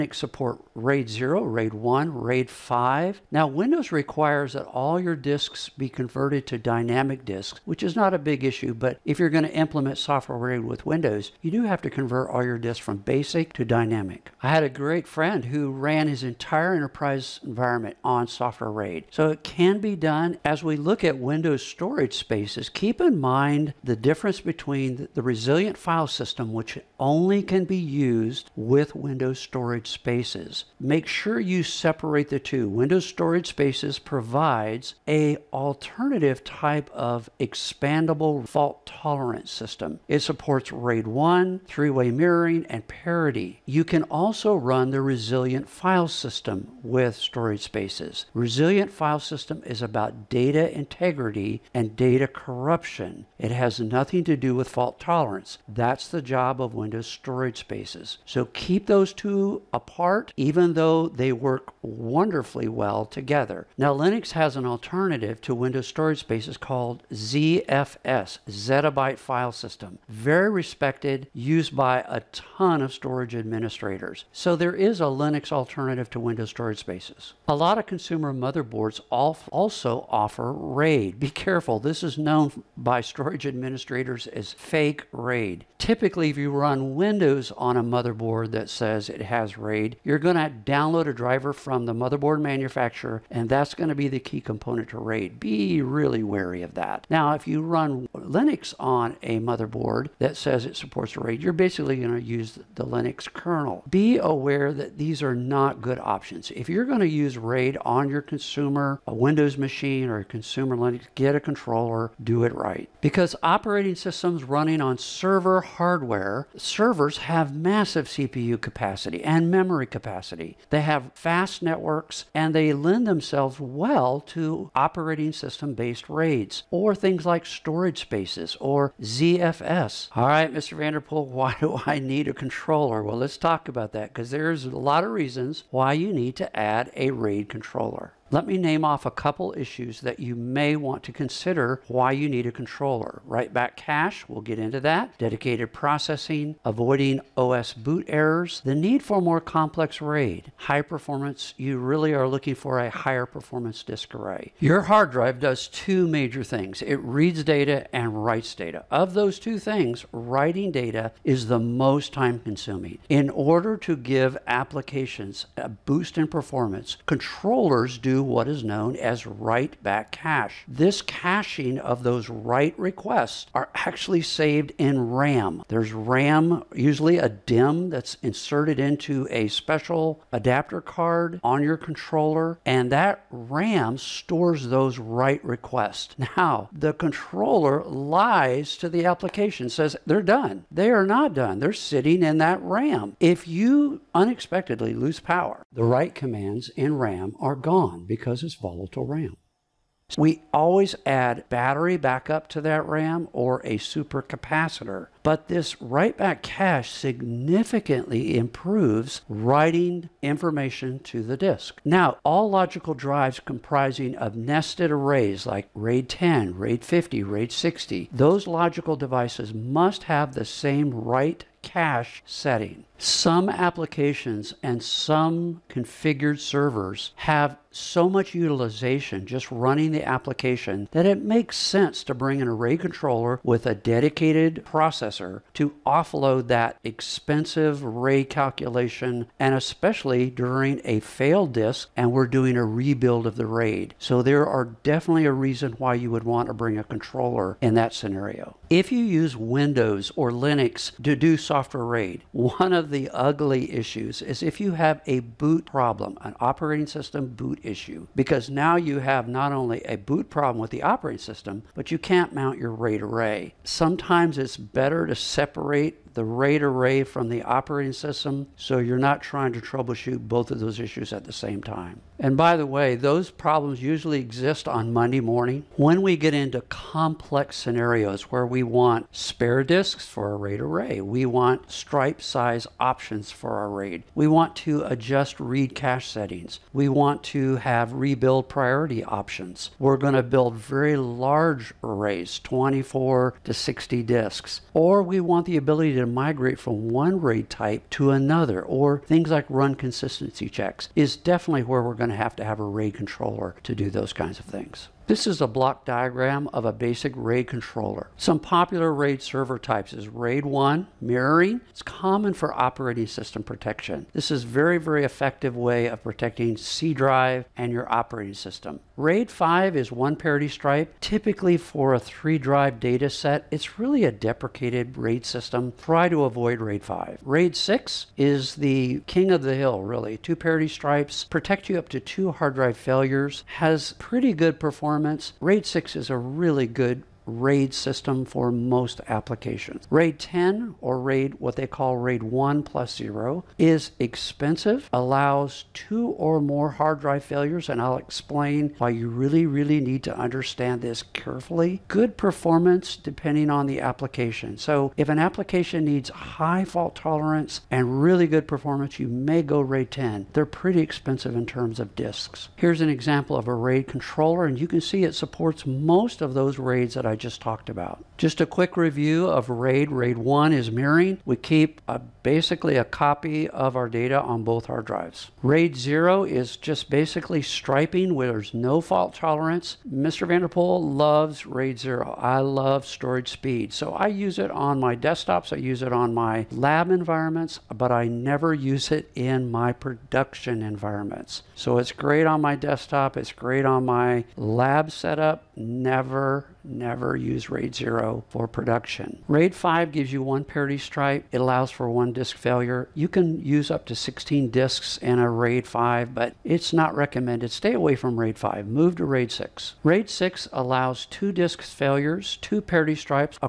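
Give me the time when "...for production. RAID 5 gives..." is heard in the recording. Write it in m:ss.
6:38.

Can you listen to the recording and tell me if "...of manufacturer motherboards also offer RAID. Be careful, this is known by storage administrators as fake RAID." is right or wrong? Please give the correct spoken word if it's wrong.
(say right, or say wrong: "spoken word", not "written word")
wrong: "consumer", not "manufacturer".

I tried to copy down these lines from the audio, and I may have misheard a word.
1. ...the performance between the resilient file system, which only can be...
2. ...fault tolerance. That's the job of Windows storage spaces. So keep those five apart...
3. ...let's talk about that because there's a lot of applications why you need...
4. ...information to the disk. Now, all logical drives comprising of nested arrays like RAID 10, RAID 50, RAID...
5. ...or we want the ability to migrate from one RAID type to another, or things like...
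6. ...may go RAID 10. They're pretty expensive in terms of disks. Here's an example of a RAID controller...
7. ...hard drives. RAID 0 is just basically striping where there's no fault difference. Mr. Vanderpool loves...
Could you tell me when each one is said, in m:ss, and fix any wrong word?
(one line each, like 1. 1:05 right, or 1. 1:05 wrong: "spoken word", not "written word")
1. 0:23 wrong: "difference", not "performance"
2. 0:54 wrong: "two", not "five"
3. 2:13 wrong: "reasons", not "applications"
4. 3:30 right
5. 4:54 right
6. 5:59 right
7. 6:14 wrong: "tolerance", not "difference".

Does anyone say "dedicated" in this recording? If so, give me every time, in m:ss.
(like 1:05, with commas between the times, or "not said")
2:25, 3:53.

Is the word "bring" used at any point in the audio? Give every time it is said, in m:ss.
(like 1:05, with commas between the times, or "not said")
3:52, 4:06.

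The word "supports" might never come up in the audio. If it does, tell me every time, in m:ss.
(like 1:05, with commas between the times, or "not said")
0:00, 0:40, 1:40, 6:05.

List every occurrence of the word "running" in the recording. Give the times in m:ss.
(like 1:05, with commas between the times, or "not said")
1:54, 3:49.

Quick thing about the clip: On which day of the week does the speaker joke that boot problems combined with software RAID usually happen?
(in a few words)
Monday.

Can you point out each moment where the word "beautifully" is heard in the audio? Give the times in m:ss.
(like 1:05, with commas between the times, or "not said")
not said.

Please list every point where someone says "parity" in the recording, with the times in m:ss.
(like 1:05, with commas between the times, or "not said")
0:42, 5:20, 5:30, 6:40, 6:52.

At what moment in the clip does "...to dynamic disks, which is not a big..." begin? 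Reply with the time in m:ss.
0:06.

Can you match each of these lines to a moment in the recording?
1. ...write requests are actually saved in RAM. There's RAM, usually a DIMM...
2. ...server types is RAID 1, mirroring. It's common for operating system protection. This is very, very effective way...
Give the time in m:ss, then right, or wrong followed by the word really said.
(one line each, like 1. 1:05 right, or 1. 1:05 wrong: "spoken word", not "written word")
1. 2:52 right
2. 5:09 right.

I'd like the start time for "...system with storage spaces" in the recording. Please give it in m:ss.
0:46.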